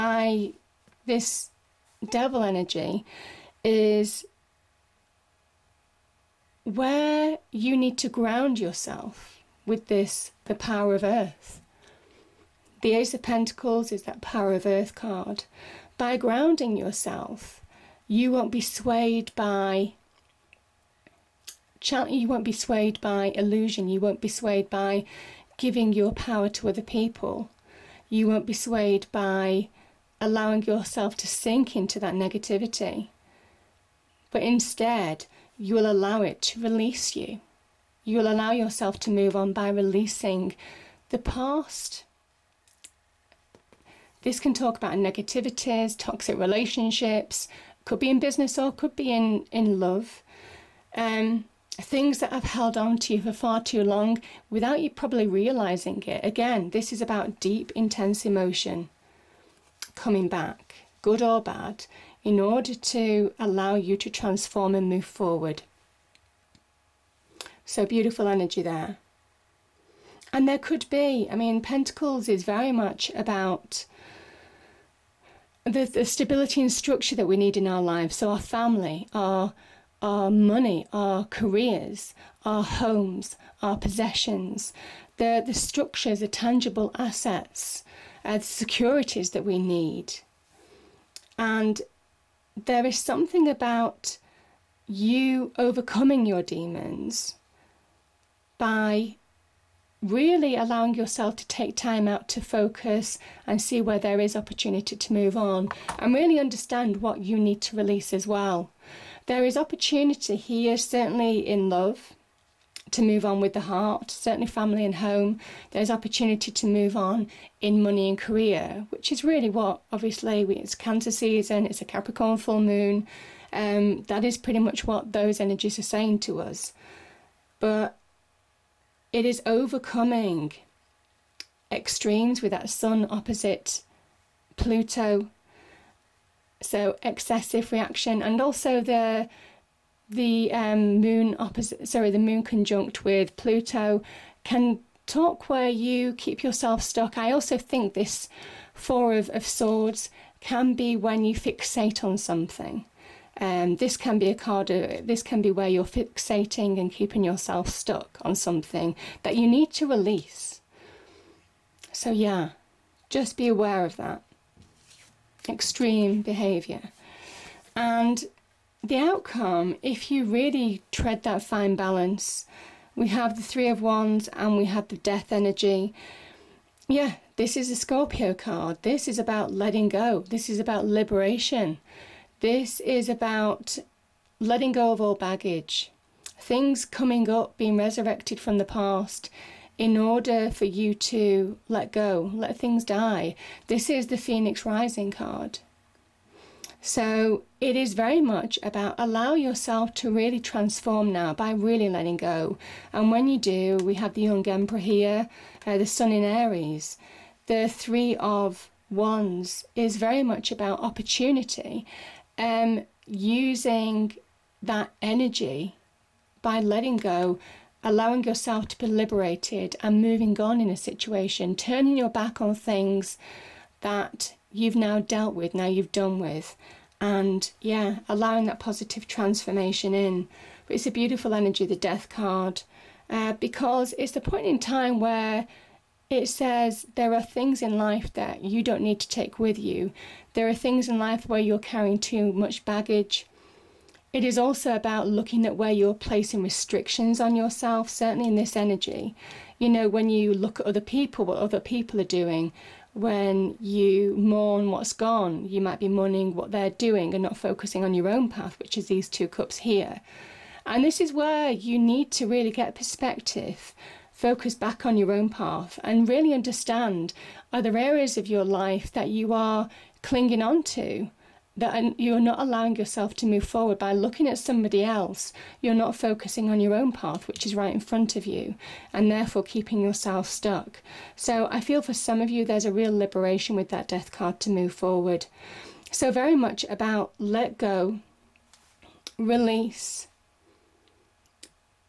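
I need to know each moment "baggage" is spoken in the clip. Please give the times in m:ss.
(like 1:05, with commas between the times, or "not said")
3:05, 4:02.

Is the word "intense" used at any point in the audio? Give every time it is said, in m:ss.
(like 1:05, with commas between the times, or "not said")
0:57.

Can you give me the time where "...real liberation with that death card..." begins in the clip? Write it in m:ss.
4:42.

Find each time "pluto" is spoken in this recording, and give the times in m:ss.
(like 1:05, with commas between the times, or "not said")
2:14, 2:23.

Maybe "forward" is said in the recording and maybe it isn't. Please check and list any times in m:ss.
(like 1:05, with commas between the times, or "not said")
1:05, 4:33, 4:44.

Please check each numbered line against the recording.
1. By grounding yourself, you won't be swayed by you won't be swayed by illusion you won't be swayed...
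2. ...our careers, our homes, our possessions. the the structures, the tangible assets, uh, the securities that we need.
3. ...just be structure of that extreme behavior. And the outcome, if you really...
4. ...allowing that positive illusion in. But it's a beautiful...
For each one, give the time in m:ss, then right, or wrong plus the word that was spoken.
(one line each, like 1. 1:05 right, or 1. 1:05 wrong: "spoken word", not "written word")
1. 0:15 right
2. 1:20 right
3. 2:43 wrong: "aware", not "structure"
4. 3:48 wrong: "transformation", not "illusion".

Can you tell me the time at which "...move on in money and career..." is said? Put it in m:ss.
1:56.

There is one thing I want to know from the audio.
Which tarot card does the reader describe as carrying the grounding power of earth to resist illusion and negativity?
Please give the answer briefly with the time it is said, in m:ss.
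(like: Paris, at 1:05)
Ace of Pentacles, at 0:12.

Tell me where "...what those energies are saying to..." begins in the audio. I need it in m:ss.
2:04.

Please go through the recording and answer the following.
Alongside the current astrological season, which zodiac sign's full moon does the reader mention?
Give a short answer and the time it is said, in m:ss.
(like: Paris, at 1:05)
Capricorn, at 2:01.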